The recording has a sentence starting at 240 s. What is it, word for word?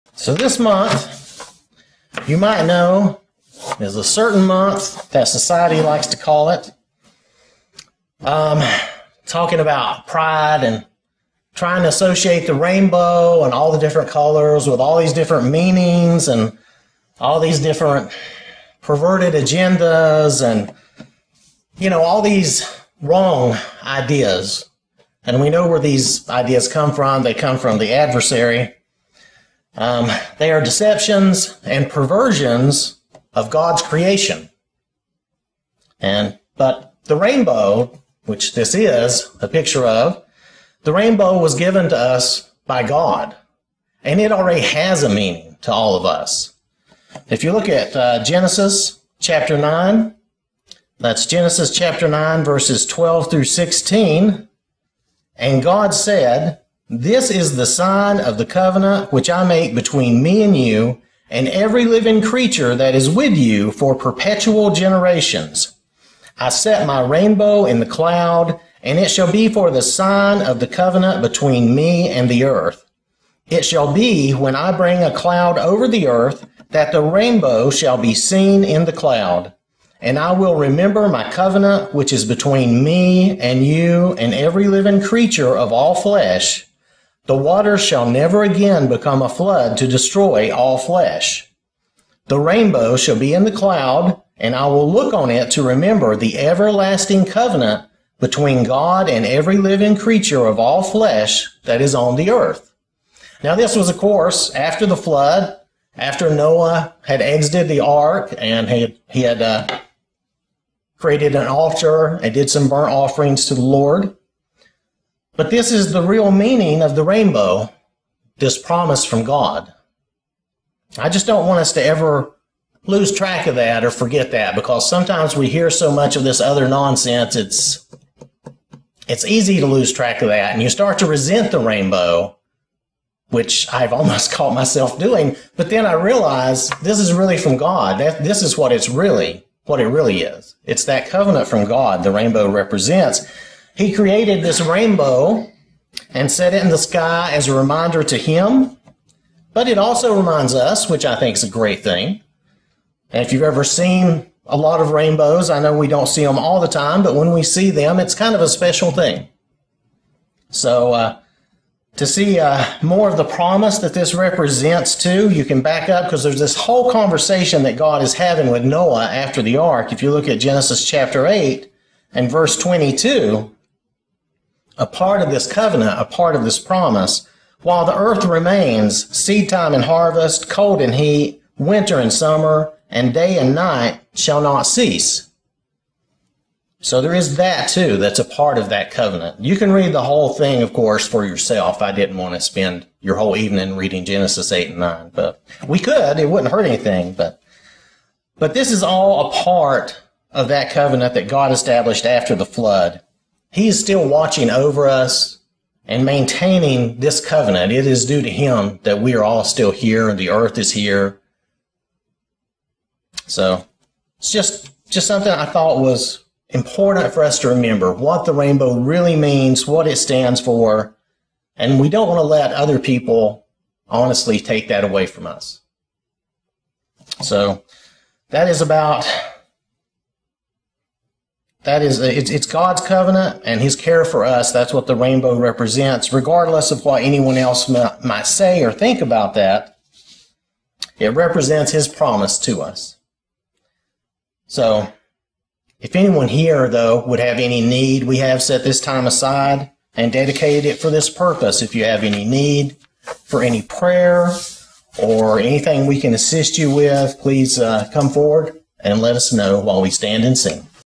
It represents His promise to us.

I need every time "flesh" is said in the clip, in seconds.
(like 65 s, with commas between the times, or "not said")
85 s, 90 s, 100 s.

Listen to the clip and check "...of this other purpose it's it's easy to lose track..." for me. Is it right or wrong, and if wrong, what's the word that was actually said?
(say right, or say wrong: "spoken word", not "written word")
wrong: "nonsense", not "purpose".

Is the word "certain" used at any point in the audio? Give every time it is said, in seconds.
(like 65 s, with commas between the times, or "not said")
4 s.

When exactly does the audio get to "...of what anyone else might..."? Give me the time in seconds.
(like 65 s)
236 s.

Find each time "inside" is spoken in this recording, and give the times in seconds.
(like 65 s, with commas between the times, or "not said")
not said.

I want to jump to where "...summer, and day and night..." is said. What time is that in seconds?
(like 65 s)
182 s.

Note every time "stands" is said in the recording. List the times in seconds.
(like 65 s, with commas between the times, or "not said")
219 s, 259 s.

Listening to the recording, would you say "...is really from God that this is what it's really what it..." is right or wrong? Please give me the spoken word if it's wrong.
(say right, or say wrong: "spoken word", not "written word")
right.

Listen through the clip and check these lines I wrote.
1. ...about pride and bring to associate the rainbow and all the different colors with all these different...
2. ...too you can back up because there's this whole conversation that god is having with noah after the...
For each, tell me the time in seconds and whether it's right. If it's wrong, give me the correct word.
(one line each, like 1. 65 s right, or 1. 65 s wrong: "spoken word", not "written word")
1. 9 s wrong: "trying", not "bring"
2. 164 s right.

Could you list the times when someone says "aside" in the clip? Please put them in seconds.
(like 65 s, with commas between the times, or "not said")
249 s.